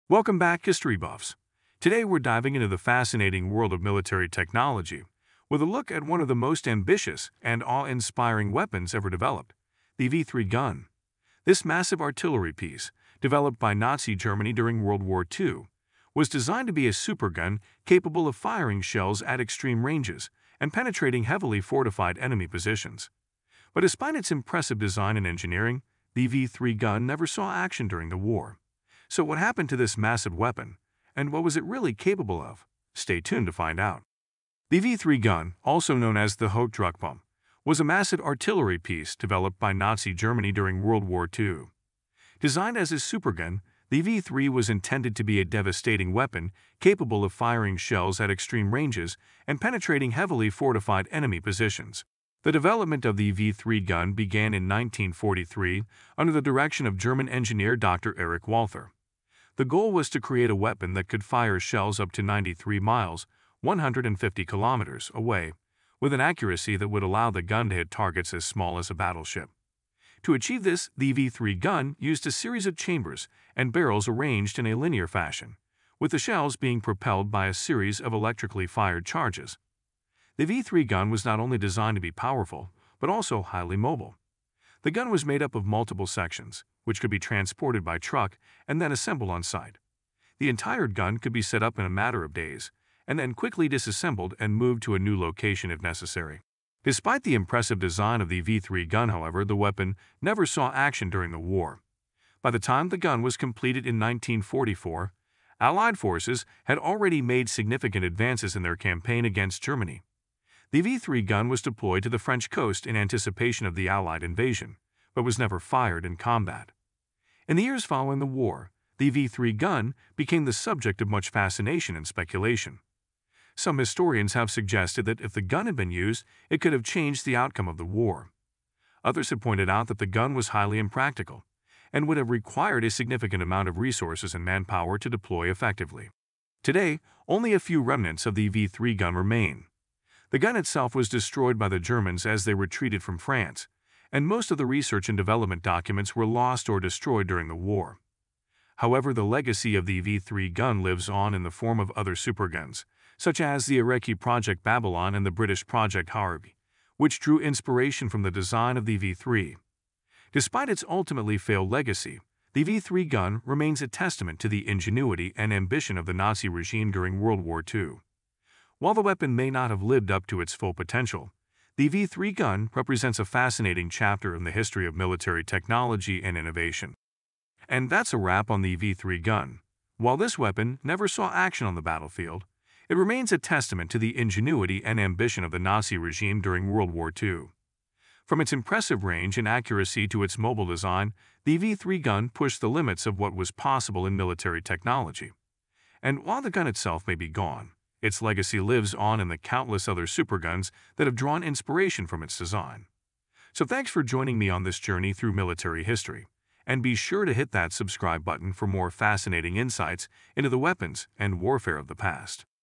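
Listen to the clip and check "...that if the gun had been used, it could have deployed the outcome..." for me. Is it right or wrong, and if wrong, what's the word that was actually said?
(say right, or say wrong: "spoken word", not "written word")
wrong: "changed", not "deployed".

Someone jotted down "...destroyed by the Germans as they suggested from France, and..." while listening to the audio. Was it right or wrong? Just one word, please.
wrong.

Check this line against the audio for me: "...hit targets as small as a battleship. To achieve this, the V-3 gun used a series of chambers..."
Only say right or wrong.
right.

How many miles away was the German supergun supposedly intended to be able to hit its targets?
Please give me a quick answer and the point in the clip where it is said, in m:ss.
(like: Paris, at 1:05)
93 miles, at 1:02.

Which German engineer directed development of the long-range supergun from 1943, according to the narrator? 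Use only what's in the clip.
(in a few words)
Dr. Erich Walther.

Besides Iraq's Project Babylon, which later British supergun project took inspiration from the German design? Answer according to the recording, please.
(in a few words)
Project Harvey.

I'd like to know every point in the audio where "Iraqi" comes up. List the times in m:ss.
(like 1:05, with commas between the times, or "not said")
2:33.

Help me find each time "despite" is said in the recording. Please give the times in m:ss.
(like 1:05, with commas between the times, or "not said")
0:23, 1:36, 2:40.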